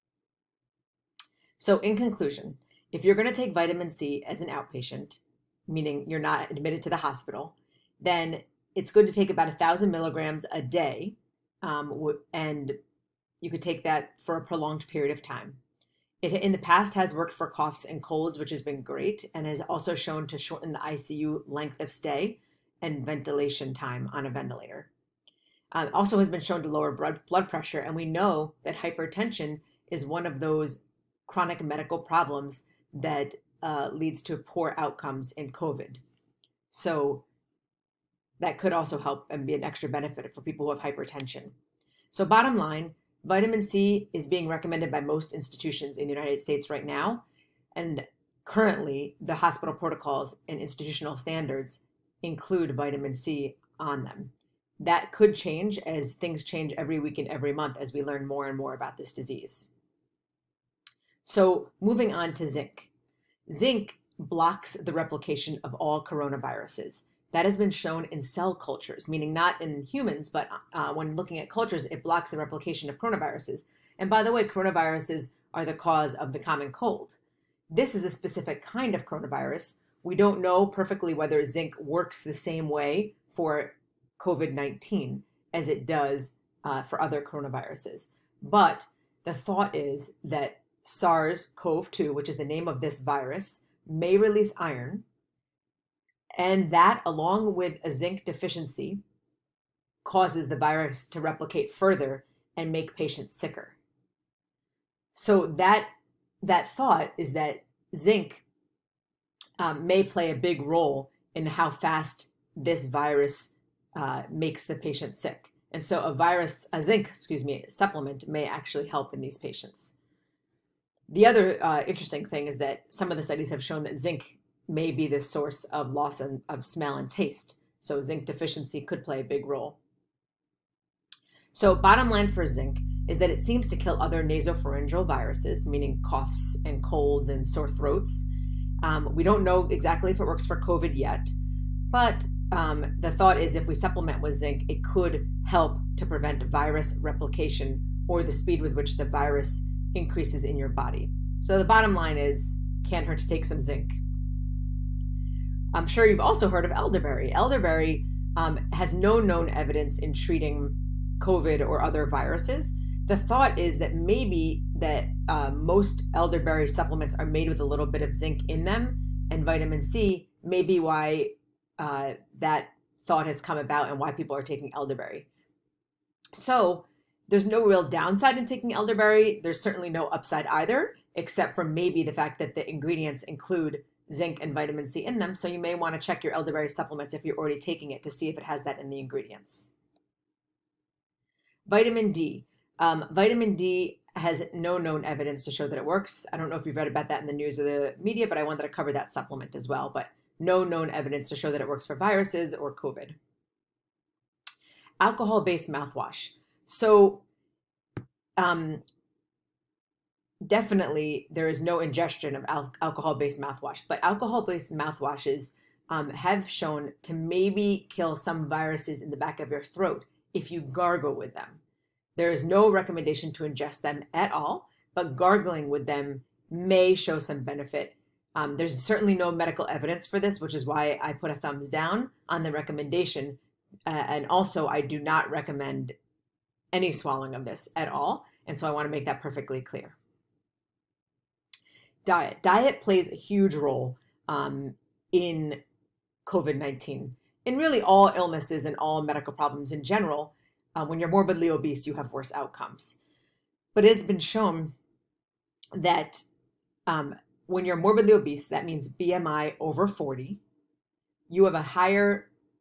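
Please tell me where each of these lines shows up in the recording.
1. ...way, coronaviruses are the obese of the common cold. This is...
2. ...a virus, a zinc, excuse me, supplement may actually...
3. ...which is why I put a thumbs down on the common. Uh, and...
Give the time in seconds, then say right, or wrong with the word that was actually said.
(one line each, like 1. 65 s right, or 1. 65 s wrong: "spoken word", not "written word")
1. 74 s wrong: "cause", not "obese"
2. 116 s right
3. 230 s wrong: "recommendation", not "common".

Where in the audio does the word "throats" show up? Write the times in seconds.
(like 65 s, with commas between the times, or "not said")
137 s, 219 s.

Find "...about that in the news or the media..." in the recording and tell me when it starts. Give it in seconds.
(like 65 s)
196 s.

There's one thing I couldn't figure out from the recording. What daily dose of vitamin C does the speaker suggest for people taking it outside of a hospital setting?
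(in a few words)
1,000 milligrams.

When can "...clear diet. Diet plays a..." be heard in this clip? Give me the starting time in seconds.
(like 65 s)
239 s.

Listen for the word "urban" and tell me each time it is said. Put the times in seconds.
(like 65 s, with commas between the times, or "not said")
not said.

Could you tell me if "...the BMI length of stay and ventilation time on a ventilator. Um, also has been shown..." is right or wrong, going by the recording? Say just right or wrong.
wrong.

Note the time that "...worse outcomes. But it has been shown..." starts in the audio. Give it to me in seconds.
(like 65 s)
252 s.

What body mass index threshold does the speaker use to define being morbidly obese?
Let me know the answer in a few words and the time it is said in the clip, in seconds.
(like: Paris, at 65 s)
over 40, at 258 s.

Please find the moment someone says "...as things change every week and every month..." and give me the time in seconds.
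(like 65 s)
55 s.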